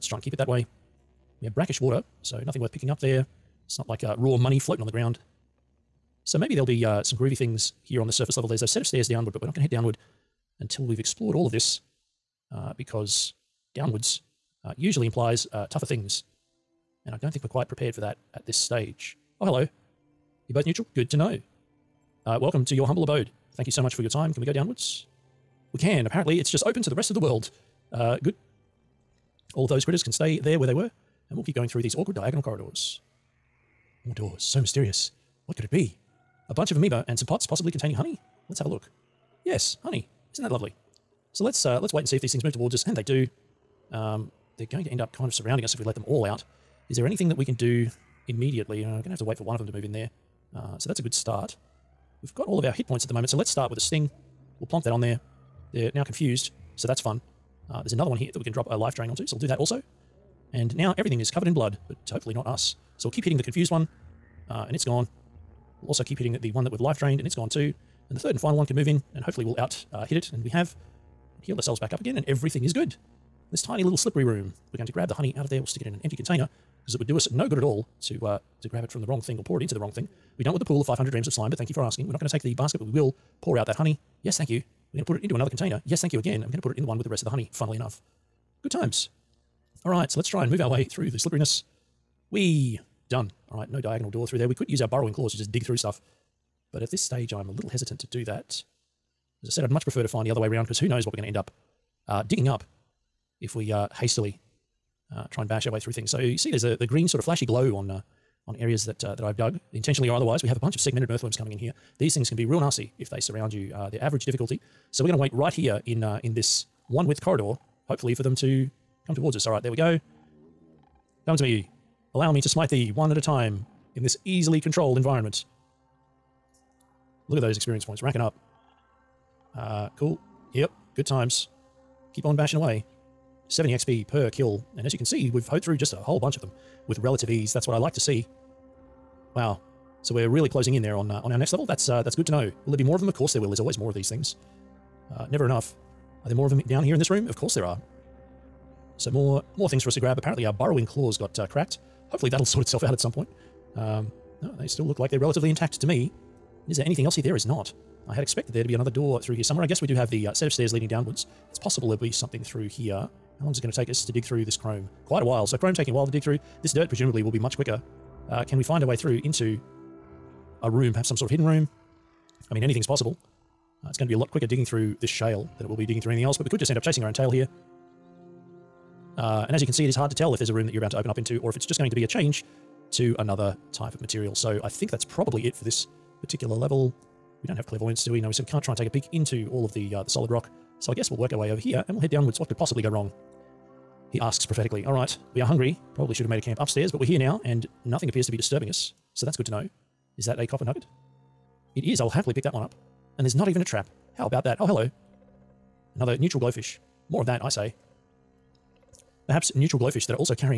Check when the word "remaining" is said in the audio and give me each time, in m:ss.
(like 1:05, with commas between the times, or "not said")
not said.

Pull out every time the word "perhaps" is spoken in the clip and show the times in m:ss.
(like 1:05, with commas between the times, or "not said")
2:50, 3:29.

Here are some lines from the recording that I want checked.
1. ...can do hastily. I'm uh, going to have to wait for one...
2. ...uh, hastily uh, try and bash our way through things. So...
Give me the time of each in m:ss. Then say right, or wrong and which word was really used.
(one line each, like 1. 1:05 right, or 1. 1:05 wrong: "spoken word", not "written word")
1. 0:47 wrong: "immediately", not "hastily"
2. 1:43 right.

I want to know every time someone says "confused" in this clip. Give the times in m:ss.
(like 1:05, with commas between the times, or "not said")
0:56, 1:03.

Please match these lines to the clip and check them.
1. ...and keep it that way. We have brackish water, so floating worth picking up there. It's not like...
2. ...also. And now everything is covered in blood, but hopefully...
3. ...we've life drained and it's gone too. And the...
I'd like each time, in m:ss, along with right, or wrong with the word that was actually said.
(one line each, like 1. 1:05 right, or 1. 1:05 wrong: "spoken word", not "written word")
1. 0:00 wrong: "nothing", not "floating"
2. 0:59 right
3. 1:06 right.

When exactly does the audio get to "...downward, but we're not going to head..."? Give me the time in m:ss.
0:09.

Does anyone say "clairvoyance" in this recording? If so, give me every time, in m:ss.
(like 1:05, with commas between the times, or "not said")
3:07.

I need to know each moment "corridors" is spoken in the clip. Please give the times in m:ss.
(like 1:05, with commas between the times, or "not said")
0:32, 1:57.